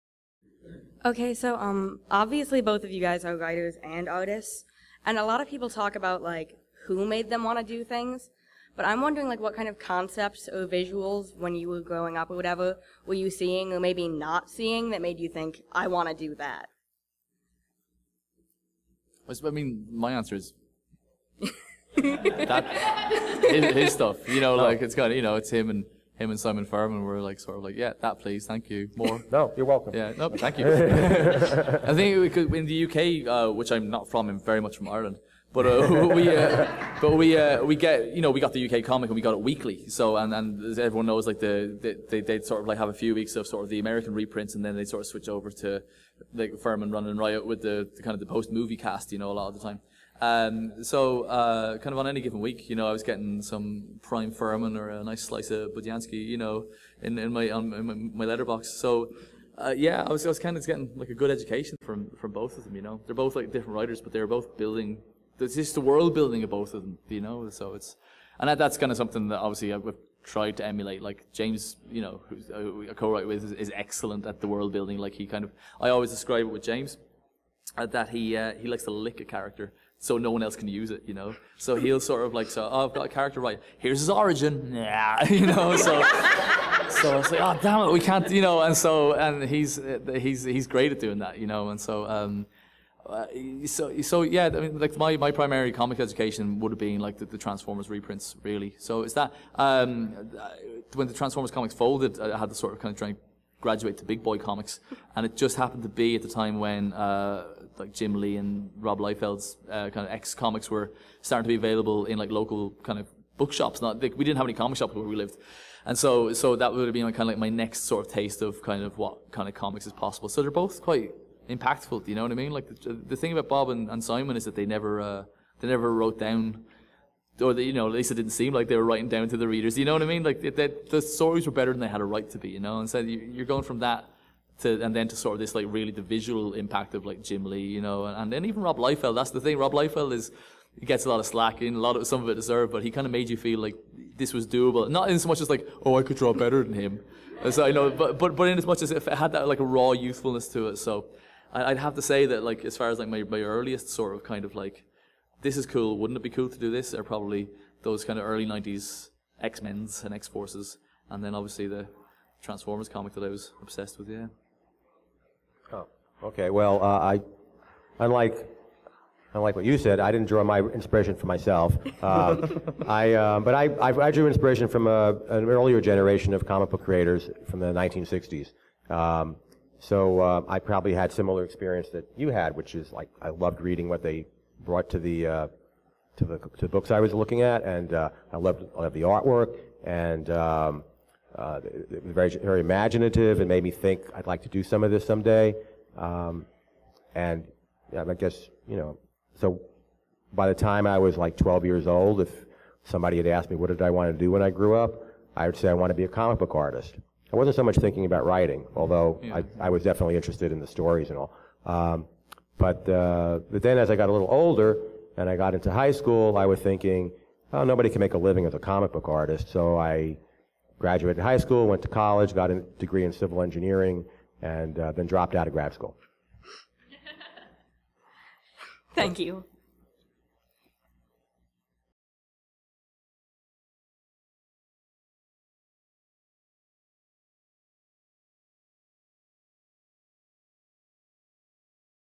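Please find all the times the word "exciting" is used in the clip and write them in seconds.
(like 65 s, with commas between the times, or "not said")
not said.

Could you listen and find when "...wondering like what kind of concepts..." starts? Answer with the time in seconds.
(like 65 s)
9 s.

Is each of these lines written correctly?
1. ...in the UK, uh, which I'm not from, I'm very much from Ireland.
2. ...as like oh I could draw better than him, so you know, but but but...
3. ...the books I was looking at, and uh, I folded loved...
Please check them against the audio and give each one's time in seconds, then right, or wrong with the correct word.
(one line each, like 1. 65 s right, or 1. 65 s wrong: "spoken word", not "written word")
1. 32 s right
2. 145 s right
3. 186 s wrong: "loved", not "folded".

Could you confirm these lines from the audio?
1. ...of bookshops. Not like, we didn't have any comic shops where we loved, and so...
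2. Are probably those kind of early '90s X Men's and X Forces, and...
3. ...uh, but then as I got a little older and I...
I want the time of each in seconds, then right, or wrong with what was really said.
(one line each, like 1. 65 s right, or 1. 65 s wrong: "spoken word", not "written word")
1. 112 s wrong: "lived", not "loved"
2. 156 s right
3. 212 s right.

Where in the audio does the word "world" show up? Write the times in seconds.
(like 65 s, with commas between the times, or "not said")
65 s, 74 s.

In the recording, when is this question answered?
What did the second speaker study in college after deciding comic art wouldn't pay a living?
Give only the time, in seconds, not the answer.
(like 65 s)
223 s.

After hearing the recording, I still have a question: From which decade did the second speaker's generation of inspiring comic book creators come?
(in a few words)
1960s.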